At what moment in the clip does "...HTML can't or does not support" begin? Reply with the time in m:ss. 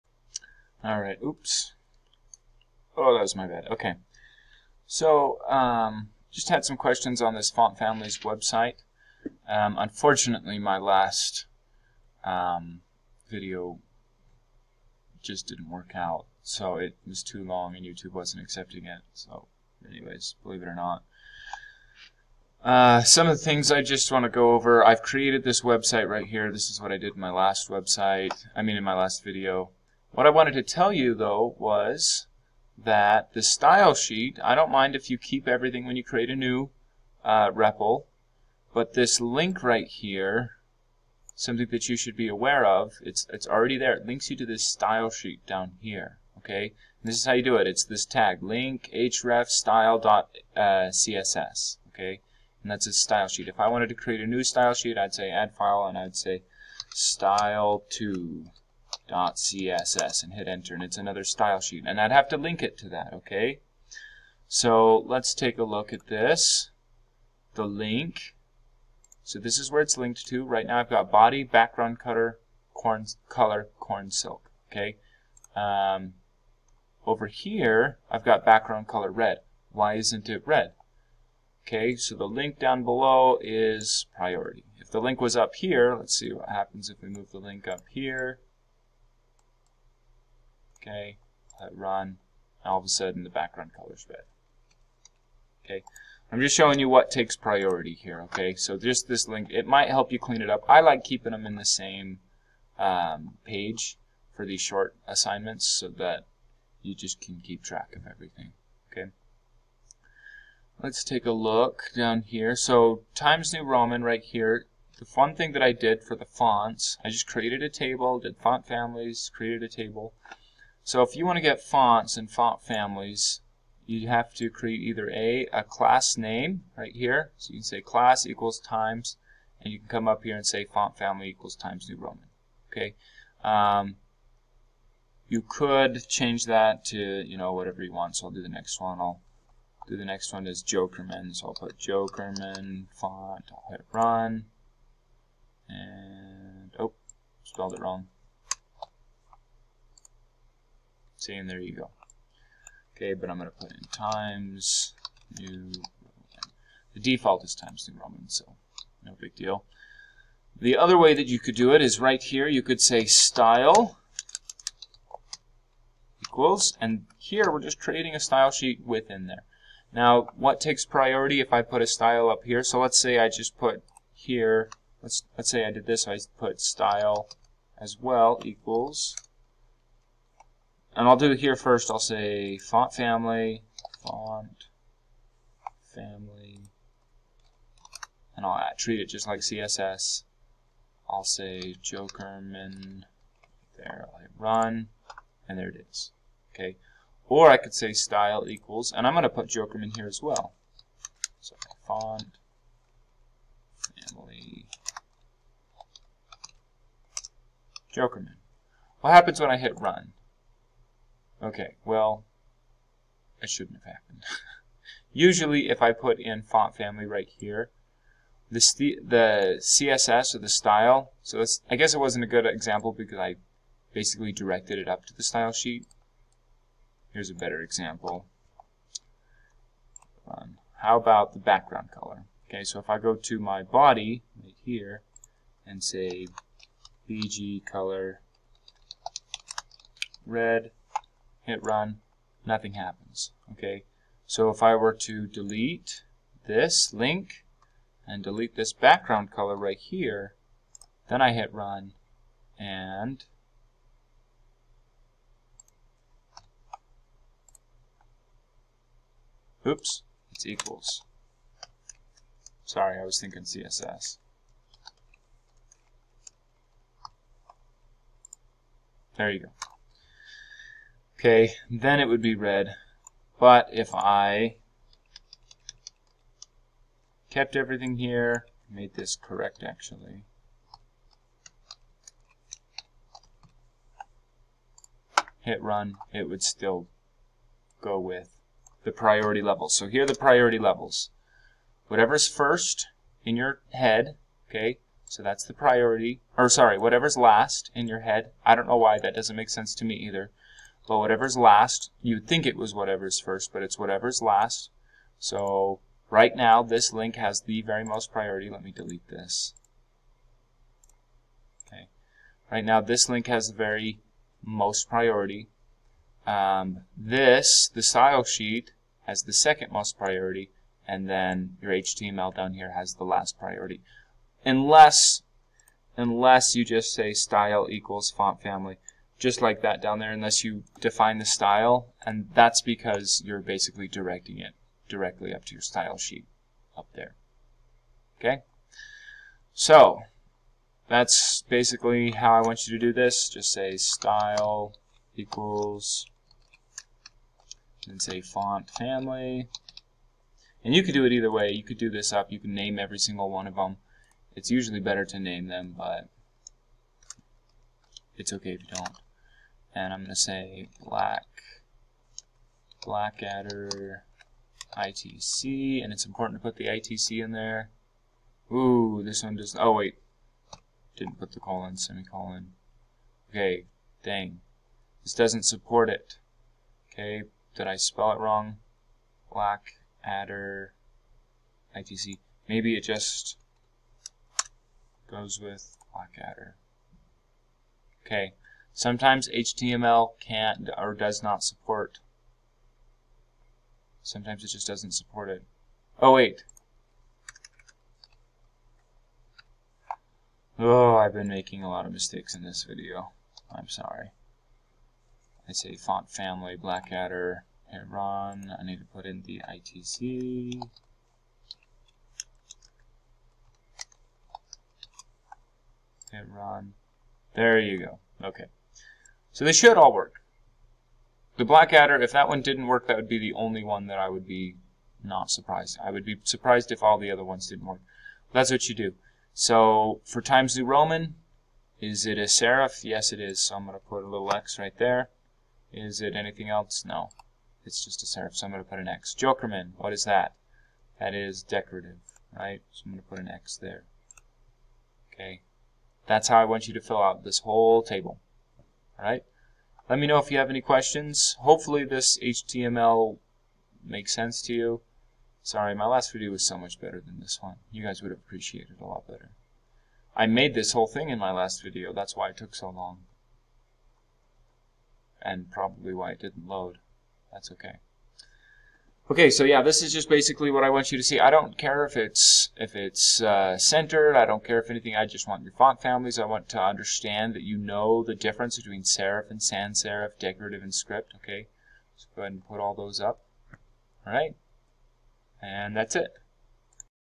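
6:29.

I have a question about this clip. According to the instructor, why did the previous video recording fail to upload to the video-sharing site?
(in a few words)
It was too long.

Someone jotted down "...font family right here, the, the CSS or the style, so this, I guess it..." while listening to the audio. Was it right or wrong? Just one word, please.
right.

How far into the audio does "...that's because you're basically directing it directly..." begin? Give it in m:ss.
5:32.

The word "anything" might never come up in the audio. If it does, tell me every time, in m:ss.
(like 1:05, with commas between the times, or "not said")
7:16, 7:54.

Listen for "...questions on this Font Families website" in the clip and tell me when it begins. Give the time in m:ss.
0:06.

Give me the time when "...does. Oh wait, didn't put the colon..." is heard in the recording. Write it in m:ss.
6:09.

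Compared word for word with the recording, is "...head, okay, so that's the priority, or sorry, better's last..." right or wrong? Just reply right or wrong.
wrong.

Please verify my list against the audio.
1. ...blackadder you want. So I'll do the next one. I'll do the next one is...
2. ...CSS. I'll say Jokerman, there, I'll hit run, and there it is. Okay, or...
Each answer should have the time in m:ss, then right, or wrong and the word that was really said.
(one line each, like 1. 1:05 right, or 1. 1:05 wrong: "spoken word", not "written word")
1. 2:17 wrong: "whatever", not "blackadder"
2. 3:09 right.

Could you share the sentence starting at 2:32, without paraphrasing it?
Okay, but I'm going to put in times new Roman.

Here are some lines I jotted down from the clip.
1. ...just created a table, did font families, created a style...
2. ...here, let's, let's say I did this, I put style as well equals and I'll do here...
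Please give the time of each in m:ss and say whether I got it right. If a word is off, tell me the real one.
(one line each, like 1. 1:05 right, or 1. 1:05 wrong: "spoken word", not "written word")
1. 1:57 wrong: "table", not "style"
2. 2:54 right.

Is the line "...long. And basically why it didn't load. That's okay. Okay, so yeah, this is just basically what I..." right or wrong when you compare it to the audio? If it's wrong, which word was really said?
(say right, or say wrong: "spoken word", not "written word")
wrong: "probably", not "basically".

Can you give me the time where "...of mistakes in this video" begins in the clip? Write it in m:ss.
6:41.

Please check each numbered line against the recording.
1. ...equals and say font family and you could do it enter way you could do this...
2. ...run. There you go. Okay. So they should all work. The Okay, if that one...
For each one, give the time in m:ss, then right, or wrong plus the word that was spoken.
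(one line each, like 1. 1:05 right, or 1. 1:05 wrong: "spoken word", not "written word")
1. 5:45 wrong: "either", not "enter"
2. 6:56 wrong: "Blackadder", not "Okay".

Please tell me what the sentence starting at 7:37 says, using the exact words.
You guys would appreciated it a lot better.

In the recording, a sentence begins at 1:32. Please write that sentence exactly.
And all of a sudden the background color's red.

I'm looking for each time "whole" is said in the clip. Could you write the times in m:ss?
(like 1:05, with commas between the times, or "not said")
7:27, 7:40.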